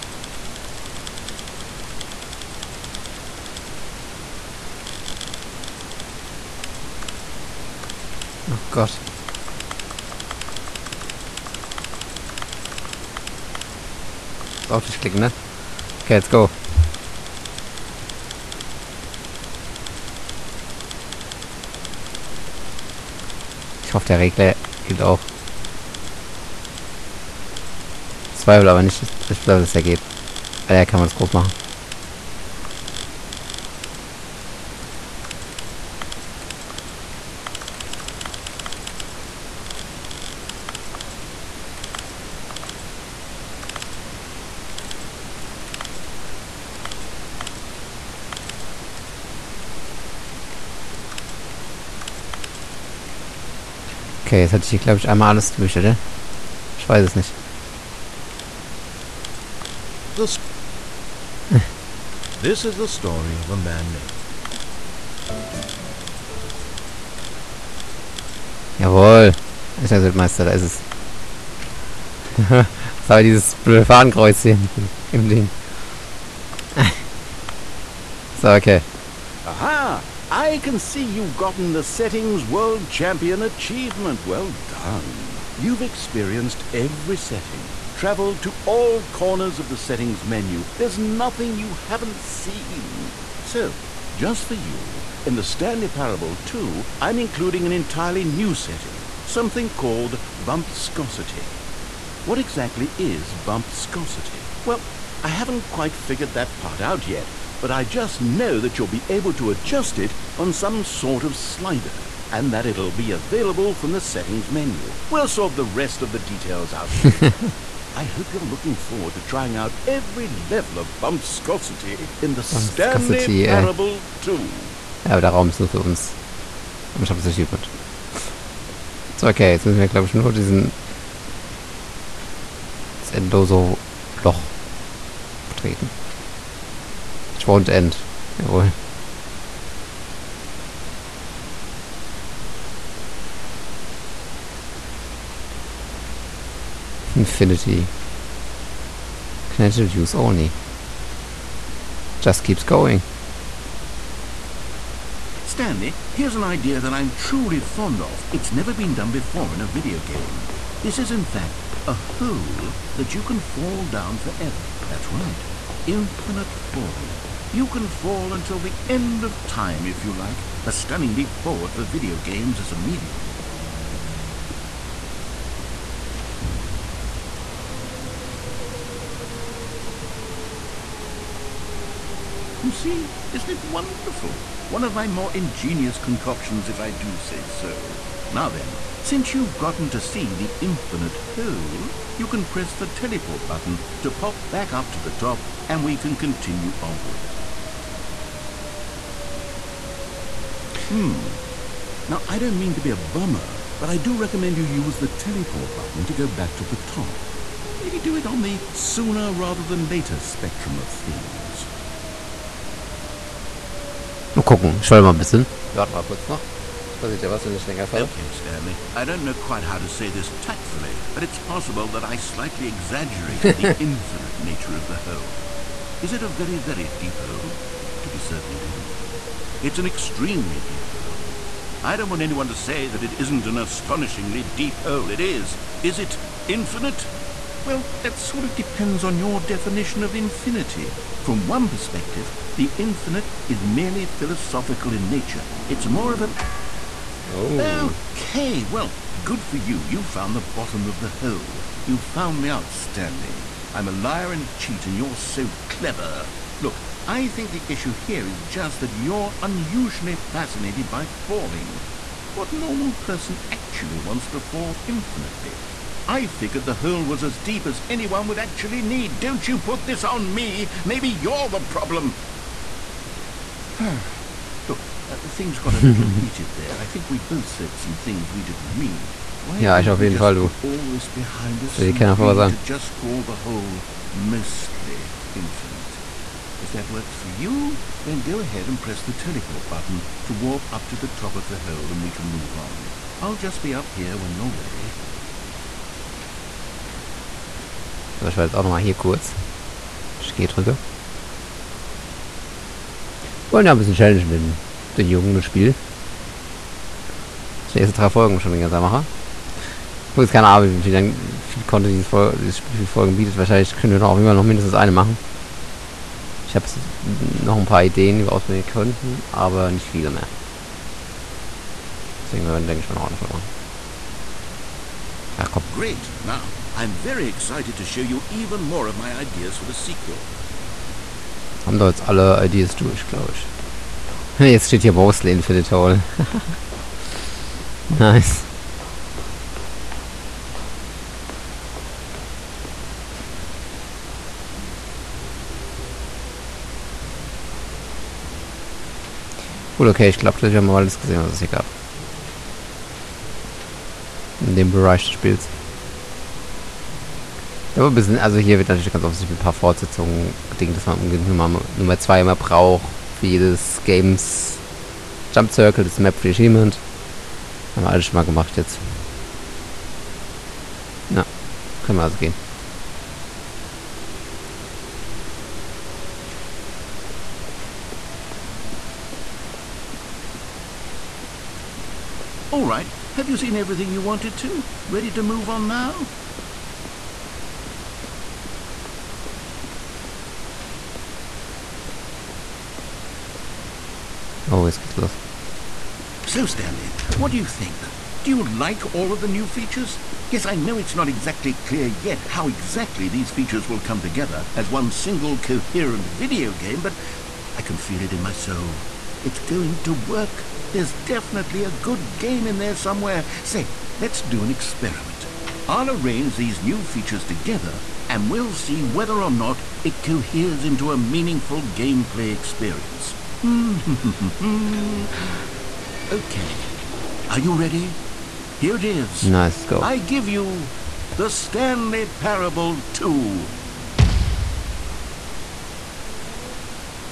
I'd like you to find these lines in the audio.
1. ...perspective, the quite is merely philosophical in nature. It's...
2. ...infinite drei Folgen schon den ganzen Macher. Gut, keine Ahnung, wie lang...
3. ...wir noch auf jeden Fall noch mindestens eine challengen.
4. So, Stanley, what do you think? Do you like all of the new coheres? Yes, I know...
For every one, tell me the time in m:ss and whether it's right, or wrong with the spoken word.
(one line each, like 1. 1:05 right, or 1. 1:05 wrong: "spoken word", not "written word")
1. 4:01 wrong: "infinite", not "quite"
2. 5:07 wrong: "erste", not "infinite"
3. 5:13 wrong: "machen", not "challengen"
4. 6:36 wrong: "features", not "coheres".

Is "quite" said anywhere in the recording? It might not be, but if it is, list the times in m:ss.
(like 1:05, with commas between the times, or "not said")
1:45, 3:39.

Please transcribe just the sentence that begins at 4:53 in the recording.
I'll just be up here when you're ready.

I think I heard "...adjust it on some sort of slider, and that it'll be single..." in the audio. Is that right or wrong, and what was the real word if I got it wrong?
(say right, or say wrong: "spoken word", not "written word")
wrong: "available", not "single".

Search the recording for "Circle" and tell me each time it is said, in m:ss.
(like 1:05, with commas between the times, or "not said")
6:05.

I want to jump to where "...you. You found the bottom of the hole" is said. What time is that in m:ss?
4:09.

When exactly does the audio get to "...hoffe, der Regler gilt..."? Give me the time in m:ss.
0:23.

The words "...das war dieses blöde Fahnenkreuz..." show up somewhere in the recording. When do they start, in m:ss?
1:12.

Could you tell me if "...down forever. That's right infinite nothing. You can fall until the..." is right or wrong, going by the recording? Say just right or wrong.
wrong.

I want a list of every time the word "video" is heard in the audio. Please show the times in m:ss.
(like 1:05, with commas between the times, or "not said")
2:39, 2:51, 6:46.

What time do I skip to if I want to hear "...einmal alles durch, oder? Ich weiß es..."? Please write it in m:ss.
0:55.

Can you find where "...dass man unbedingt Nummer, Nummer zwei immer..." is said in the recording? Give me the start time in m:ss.
6:00.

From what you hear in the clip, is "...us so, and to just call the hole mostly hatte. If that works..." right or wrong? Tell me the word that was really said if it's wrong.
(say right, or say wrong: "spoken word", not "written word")
wrong: "infinite", not "hatte".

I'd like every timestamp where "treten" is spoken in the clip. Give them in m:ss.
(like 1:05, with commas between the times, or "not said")
2:15.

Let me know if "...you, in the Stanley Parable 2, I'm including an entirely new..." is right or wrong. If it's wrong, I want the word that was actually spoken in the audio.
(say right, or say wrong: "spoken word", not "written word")
right.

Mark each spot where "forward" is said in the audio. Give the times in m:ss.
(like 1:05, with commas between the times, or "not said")
1:58, 2:51.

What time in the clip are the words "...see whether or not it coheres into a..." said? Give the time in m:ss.
6:58.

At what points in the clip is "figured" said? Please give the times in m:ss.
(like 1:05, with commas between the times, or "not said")
1:45, 4:26.